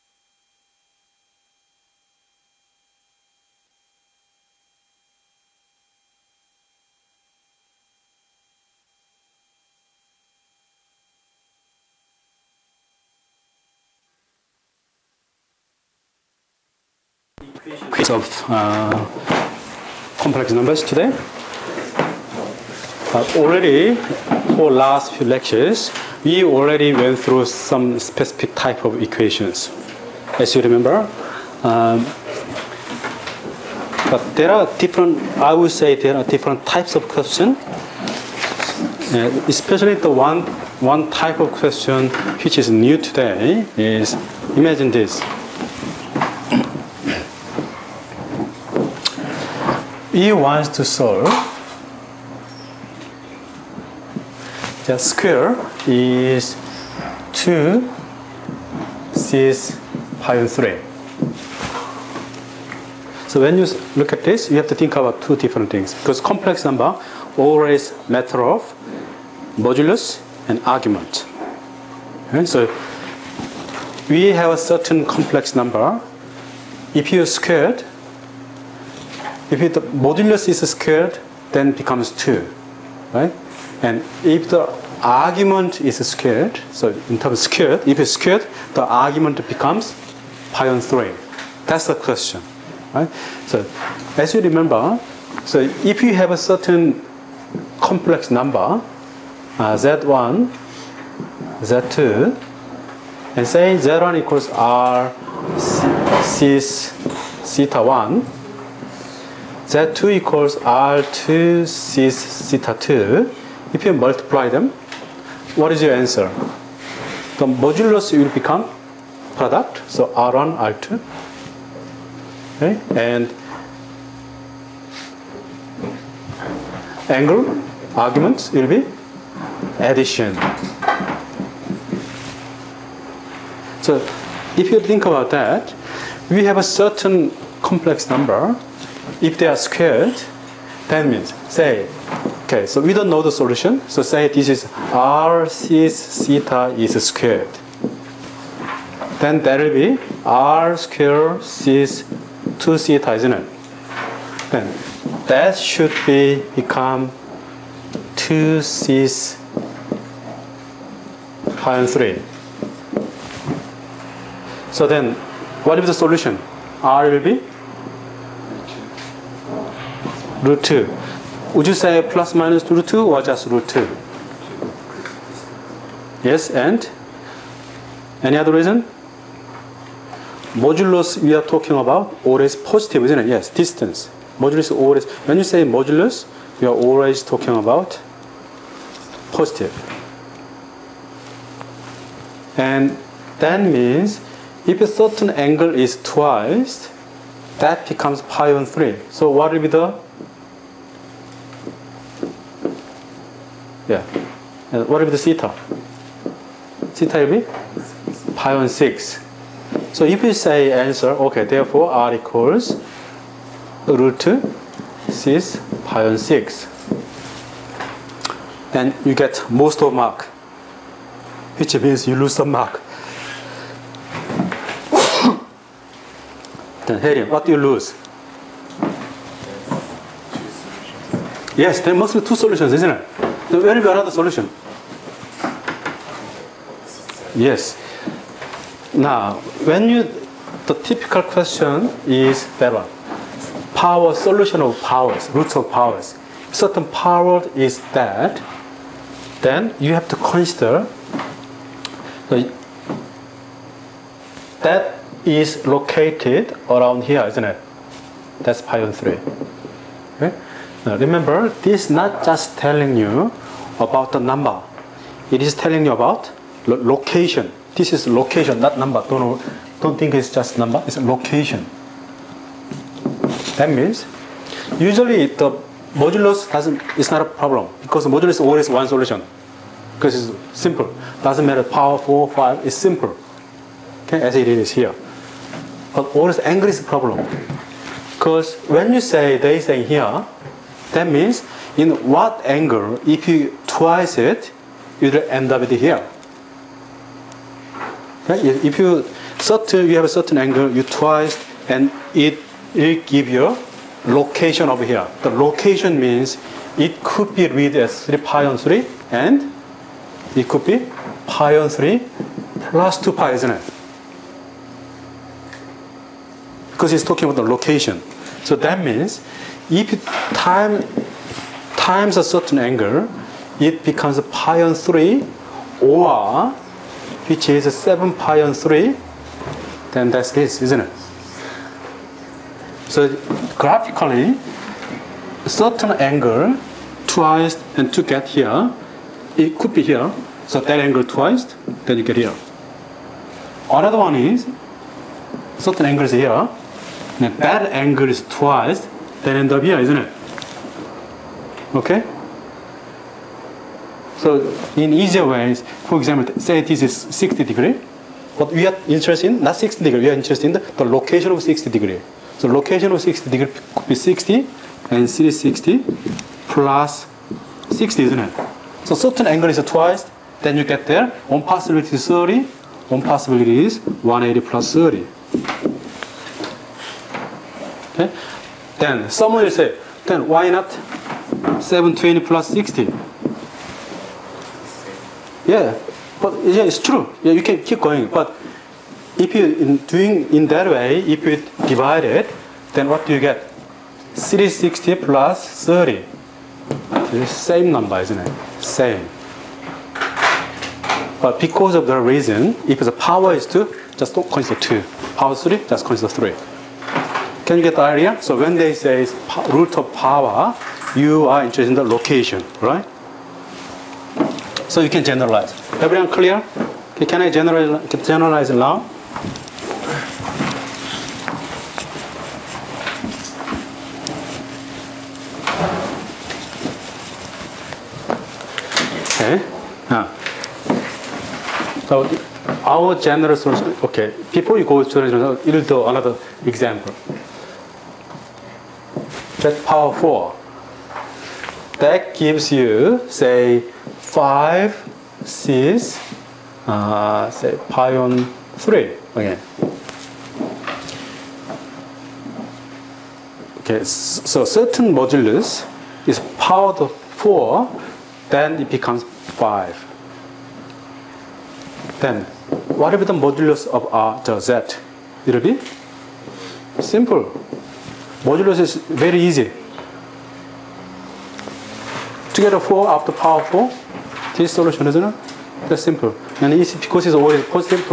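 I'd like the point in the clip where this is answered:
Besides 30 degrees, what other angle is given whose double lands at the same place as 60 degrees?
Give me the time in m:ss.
6:13.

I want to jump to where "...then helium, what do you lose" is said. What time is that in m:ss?
3:46.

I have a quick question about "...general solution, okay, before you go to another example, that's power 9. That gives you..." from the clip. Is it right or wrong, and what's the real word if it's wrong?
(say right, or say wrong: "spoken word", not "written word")
wrong: "4", not "9".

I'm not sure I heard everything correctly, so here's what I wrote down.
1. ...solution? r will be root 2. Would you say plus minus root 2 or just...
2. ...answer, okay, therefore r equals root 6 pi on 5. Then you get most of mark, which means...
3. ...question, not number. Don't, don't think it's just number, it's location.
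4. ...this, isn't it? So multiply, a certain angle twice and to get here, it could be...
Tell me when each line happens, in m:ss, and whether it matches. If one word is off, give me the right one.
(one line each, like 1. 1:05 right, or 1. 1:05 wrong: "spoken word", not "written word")
1. 2:45 right
2. 3:30 wrong: "6", not "5"
3. 4:28 wrong: "location", not "question"
4. 5:30 wrong: "graphically", not "multiply".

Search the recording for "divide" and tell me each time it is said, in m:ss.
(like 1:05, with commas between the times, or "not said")
6:31.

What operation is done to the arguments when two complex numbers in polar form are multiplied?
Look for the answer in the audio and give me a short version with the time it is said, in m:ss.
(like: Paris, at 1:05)
addition, at 2:09.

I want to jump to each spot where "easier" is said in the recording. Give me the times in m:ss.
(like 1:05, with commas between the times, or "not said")
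5:54.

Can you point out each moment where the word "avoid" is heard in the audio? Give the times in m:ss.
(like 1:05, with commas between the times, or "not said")
not said.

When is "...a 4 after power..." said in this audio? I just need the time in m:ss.
7:52.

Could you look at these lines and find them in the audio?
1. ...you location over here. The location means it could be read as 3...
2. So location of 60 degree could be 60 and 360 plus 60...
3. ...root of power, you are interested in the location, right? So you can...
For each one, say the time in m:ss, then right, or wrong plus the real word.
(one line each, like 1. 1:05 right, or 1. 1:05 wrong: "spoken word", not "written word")
1. 5:03 right
2. 6:02 right
3. 6:49 right.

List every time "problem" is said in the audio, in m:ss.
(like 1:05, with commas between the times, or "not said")
4:37, 4:46.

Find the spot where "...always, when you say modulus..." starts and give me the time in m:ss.
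3:04.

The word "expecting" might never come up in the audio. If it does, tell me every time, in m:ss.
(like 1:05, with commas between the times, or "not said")
not said.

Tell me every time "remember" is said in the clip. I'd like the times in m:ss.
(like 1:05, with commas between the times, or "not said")
0:30, 1:34, 4:20.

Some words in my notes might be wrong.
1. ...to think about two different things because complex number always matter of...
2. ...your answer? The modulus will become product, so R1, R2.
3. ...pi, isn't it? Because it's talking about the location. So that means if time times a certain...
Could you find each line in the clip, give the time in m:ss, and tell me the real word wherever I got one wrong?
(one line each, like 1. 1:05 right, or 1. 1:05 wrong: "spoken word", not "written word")
1. 1:04 right
2. 1:55 right
3. 5:13 right.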